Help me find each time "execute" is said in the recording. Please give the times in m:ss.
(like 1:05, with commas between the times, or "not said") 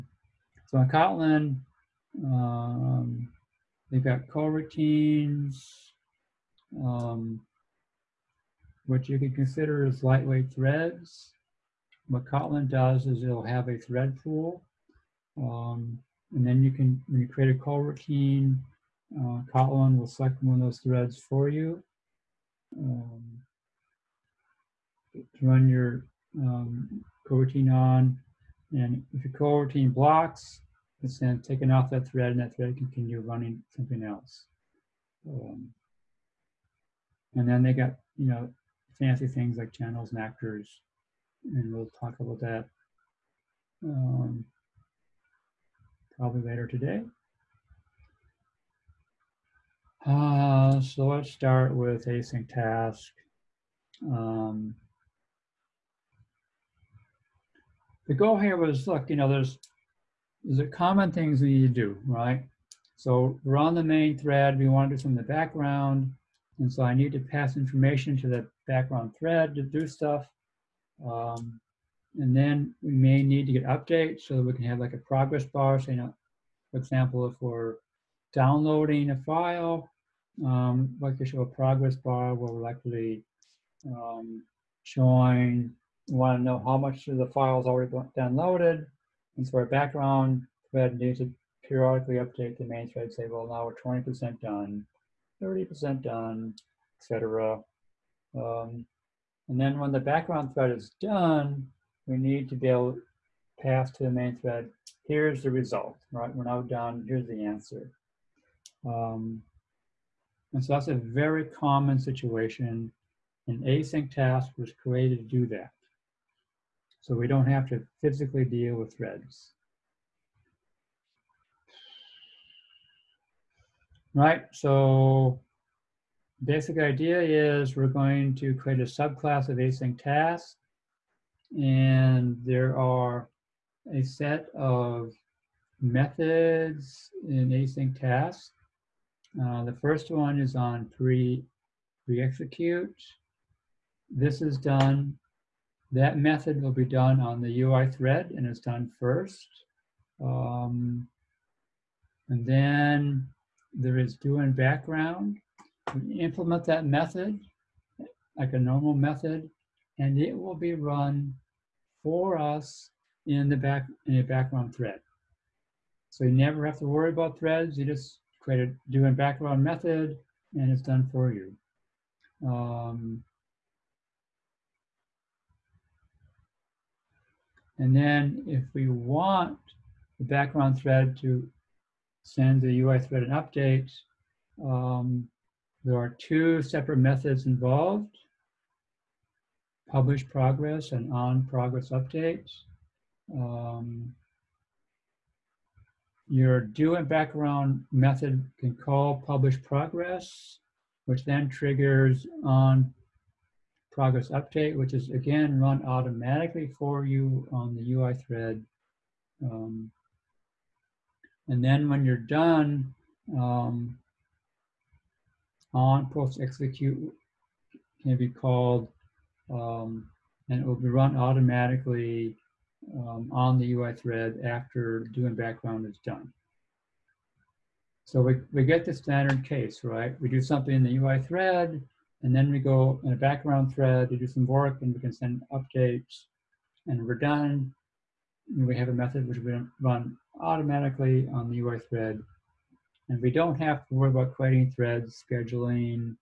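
2:22, 3:36.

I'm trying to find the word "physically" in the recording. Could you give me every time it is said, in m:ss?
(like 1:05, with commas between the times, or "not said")
1:58.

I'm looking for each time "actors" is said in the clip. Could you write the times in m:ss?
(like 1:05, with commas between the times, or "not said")
0:40.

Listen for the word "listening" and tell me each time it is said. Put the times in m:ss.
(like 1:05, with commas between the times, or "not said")
not said.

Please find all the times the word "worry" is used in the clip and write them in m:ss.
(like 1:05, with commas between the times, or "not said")
2:46, 4:03.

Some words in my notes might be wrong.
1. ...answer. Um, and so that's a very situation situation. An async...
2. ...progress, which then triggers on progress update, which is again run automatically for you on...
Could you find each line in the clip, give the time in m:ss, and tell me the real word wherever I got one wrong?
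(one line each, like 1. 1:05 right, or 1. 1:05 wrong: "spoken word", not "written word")
1. 1:47 wrong: "common", not "situation"
2. 3:19 right.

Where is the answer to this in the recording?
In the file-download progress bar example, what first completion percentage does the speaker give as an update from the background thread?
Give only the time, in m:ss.
1:34.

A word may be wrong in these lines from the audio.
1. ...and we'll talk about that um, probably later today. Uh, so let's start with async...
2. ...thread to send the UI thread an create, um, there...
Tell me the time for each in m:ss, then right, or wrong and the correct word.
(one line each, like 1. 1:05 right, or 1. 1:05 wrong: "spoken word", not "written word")
1. 0:41 right
2. 3:00 wrong: "update", not "create".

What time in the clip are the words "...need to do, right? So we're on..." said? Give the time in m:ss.
1:01.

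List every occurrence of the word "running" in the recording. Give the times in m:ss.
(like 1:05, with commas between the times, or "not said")
0:33.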